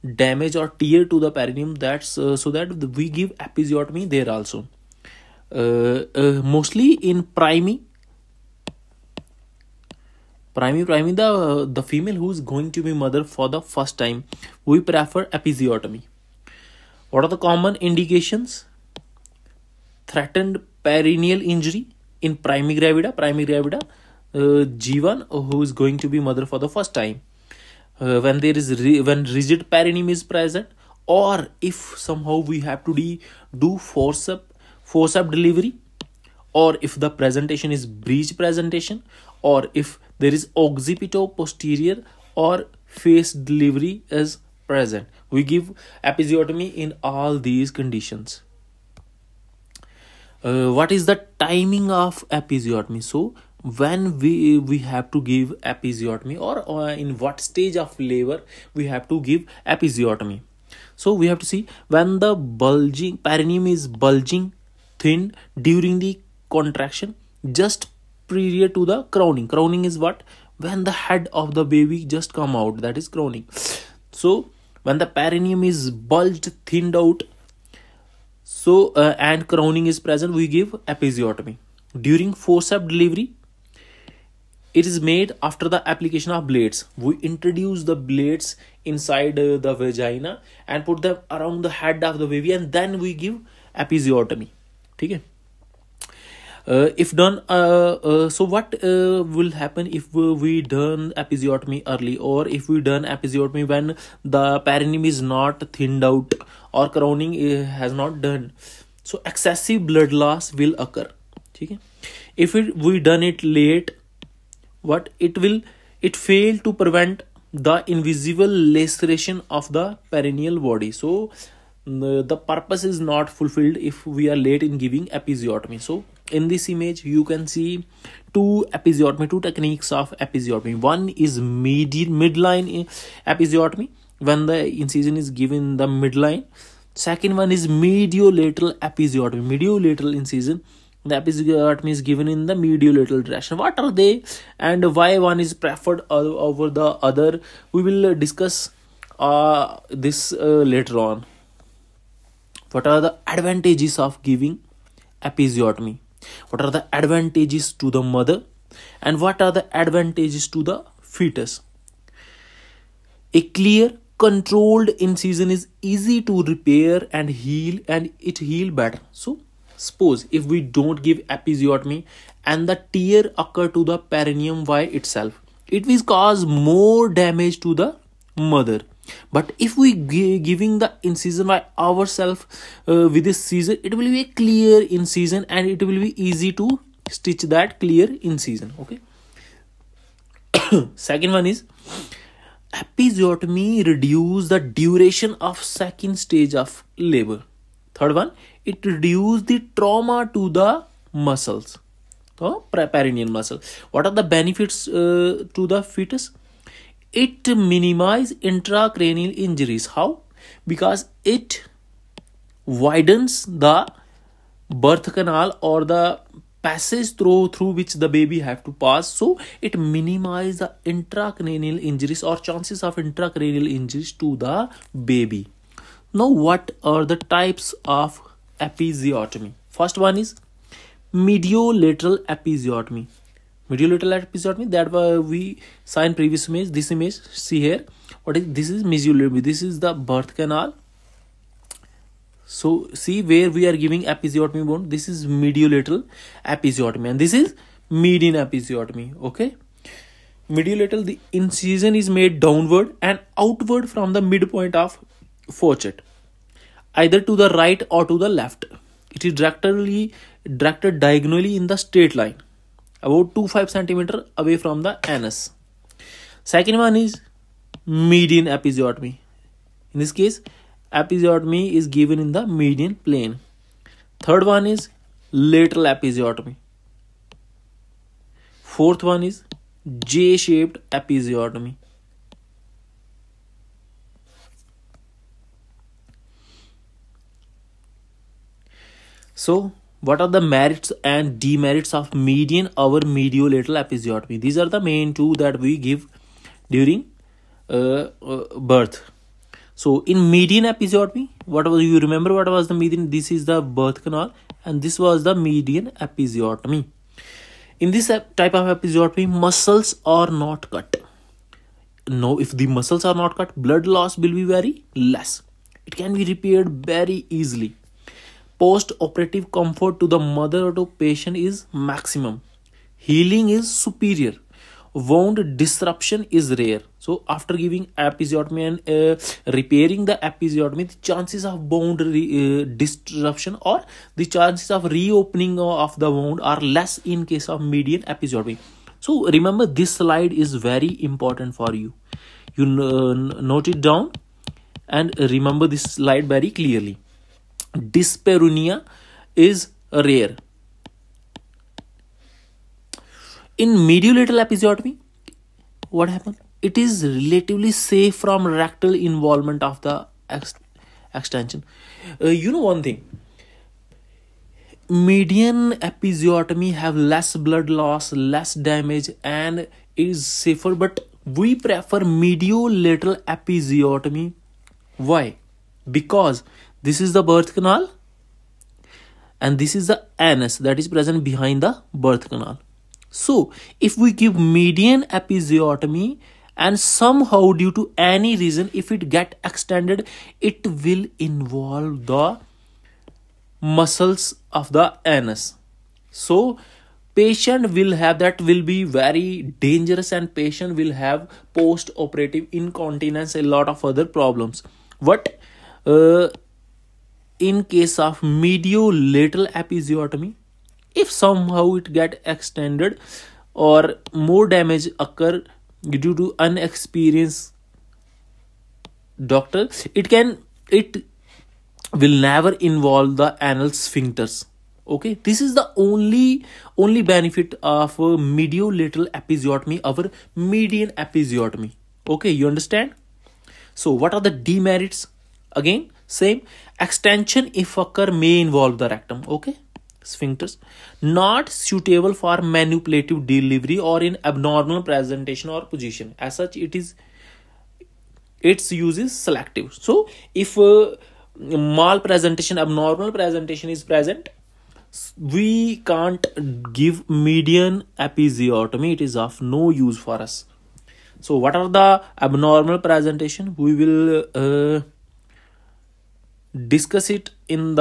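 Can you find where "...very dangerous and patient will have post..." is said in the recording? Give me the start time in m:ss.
6:38.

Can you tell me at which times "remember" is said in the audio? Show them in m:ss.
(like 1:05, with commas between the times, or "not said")
5:02, 5:39, 5:45.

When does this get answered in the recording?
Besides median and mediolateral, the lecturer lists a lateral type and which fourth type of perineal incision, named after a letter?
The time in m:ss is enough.
4:40.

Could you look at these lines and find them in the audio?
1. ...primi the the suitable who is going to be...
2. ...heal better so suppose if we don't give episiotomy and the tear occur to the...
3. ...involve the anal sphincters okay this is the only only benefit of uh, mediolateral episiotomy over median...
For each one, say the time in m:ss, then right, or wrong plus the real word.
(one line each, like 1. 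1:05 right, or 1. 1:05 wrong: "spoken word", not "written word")
1. 0:10 wrong: "female", not "suitable"
2. 2:48 right
3. 7:02 right.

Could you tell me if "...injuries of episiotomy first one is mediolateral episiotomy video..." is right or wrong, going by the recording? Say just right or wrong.
wrong.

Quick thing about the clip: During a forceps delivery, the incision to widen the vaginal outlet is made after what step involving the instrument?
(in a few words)
application of blades.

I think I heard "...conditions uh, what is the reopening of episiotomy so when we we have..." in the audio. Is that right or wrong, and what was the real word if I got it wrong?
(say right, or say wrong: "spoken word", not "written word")
wrong: "timing", not "reopening".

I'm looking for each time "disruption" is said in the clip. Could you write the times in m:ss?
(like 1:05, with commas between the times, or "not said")
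5:25, 5:32.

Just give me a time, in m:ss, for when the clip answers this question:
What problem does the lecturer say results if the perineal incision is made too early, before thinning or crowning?
1:49.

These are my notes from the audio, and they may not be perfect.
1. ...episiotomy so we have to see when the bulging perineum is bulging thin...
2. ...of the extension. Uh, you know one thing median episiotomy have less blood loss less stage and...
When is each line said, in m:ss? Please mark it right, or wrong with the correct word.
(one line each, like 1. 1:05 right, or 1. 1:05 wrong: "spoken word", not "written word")
1. 0:59 right
2. 5:59 wrong: "damage", not "stage".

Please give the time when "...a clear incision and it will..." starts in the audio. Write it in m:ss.
3:04.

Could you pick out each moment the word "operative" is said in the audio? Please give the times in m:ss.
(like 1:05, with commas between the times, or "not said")
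5:18, 6:41.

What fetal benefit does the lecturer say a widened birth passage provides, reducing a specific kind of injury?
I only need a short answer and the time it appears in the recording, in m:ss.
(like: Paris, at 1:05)
minimize intracranial injuries, at 3:27.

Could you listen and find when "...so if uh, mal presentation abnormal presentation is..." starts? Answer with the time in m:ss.
7:29.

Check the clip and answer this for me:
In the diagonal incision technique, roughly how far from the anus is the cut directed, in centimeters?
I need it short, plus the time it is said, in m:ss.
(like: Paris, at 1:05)
2.5 centimeters, at 4:23.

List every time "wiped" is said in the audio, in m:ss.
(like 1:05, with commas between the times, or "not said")
not said.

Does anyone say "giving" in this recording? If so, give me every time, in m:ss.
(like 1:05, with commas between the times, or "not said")
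2:04, 2:34, 3:00, 4:03, 5:27.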